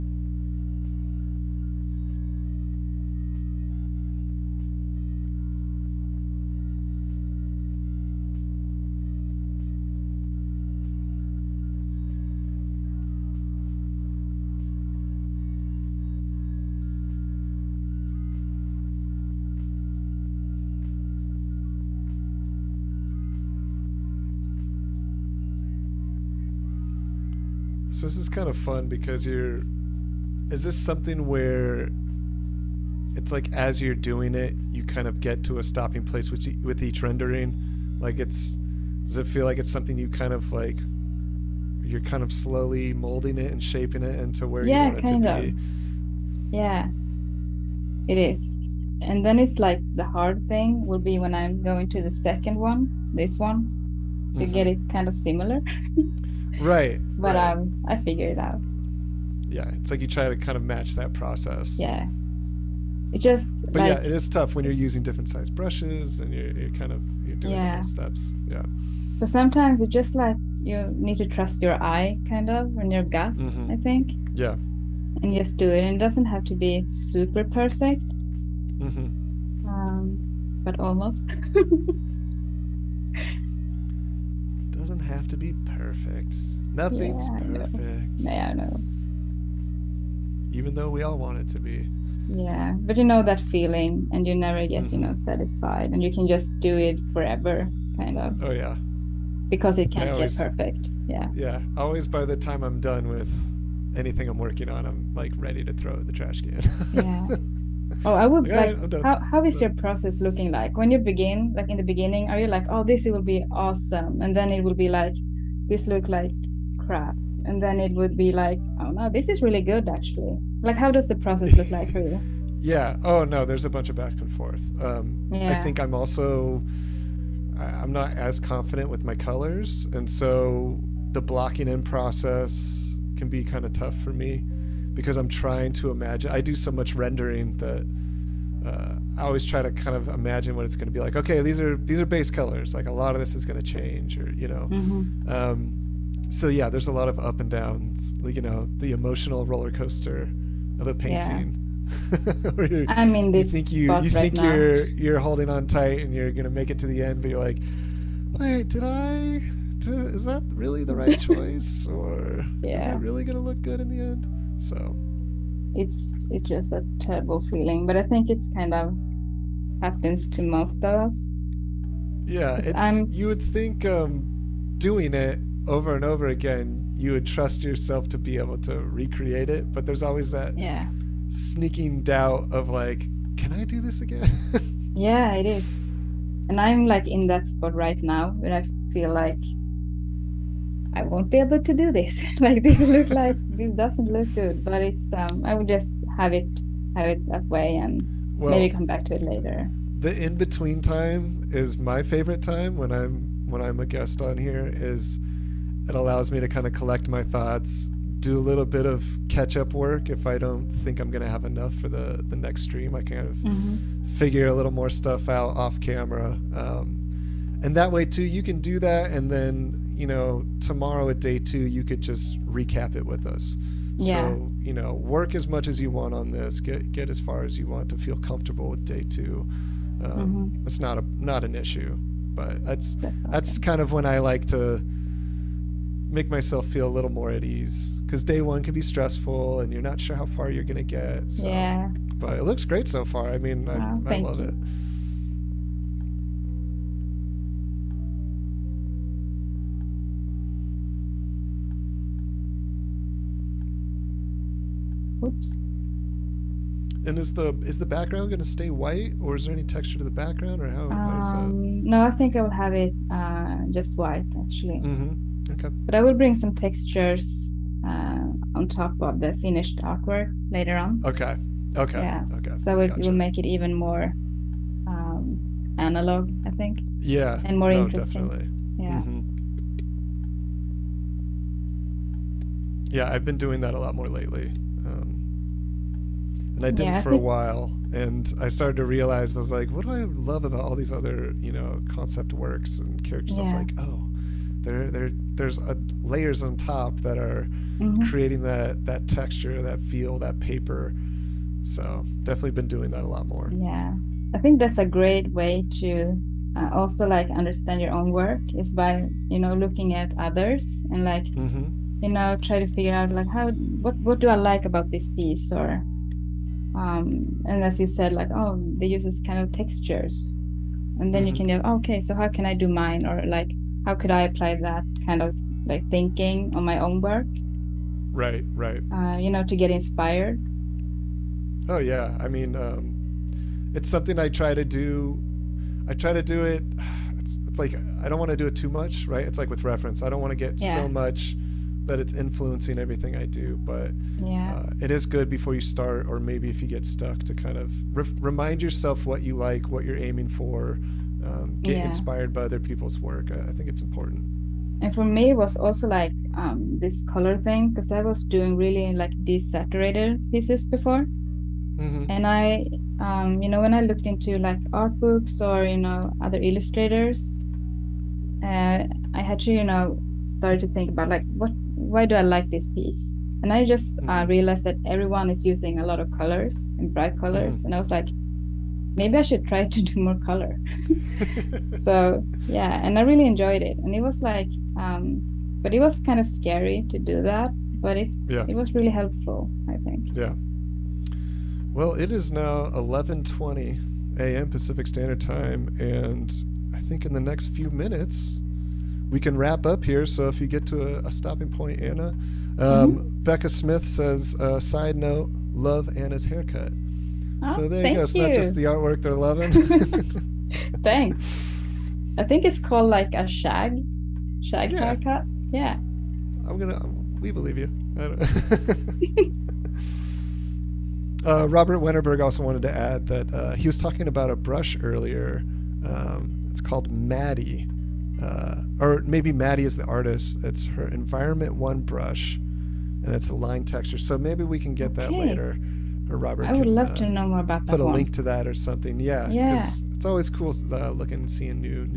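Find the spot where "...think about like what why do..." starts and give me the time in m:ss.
6:10.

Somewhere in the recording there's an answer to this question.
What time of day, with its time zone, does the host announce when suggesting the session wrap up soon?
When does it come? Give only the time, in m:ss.
6:32.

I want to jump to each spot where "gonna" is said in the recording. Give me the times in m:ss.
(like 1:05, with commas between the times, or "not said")
3:31, 6:56.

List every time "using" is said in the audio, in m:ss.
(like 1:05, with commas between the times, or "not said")
1:04, 6:15.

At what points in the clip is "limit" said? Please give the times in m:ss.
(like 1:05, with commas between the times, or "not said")
not said.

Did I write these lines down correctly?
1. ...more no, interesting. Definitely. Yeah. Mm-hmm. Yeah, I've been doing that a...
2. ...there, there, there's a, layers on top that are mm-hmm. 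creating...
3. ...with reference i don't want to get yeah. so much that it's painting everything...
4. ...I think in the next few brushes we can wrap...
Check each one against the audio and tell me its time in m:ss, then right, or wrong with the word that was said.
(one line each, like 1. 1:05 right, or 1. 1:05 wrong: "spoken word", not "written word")
1. 4:37 right
2. 4:54 right
3. 5:39 wrong: "influencing", not "painting"
4. 6:36 wrong: "minutes", not "brushes".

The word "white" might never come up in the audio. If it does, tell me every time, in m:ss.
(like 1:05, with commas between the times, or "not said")
4:18, 4:23.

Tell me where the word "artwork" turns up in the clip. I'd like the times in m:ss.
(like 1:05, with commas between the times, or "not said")
4:29, 6:48.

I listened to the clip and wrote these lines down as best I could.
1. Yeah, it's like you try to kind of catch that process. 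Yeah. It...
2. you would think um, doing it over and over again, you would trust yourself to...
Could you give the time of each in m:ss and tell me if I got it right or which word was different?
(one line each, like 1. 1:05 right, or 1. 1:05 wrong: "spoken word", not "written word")
1. 0:59 wrong: "match", not "catch"
2. 2:53 right.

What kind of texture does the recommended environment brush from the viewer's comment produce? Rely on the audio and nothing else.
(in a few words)
Line texture.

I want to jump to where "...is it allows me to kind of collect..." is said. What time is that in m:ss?
3:24.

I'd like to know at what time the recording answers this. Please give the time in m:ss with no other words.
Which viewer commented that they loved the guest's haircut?
6:43.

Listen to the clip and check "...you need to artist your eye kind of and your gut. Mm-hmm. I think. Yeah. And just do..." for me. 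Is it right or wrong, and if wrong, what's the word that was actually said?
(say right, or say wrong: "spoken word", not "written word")
wrong: "trust", not "artist".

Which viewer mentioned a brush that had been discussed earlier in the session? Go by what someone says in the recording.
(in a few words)
Robert Wennerberg.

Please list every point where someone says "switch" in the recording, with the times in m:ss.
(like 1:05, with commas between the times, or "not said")
not said.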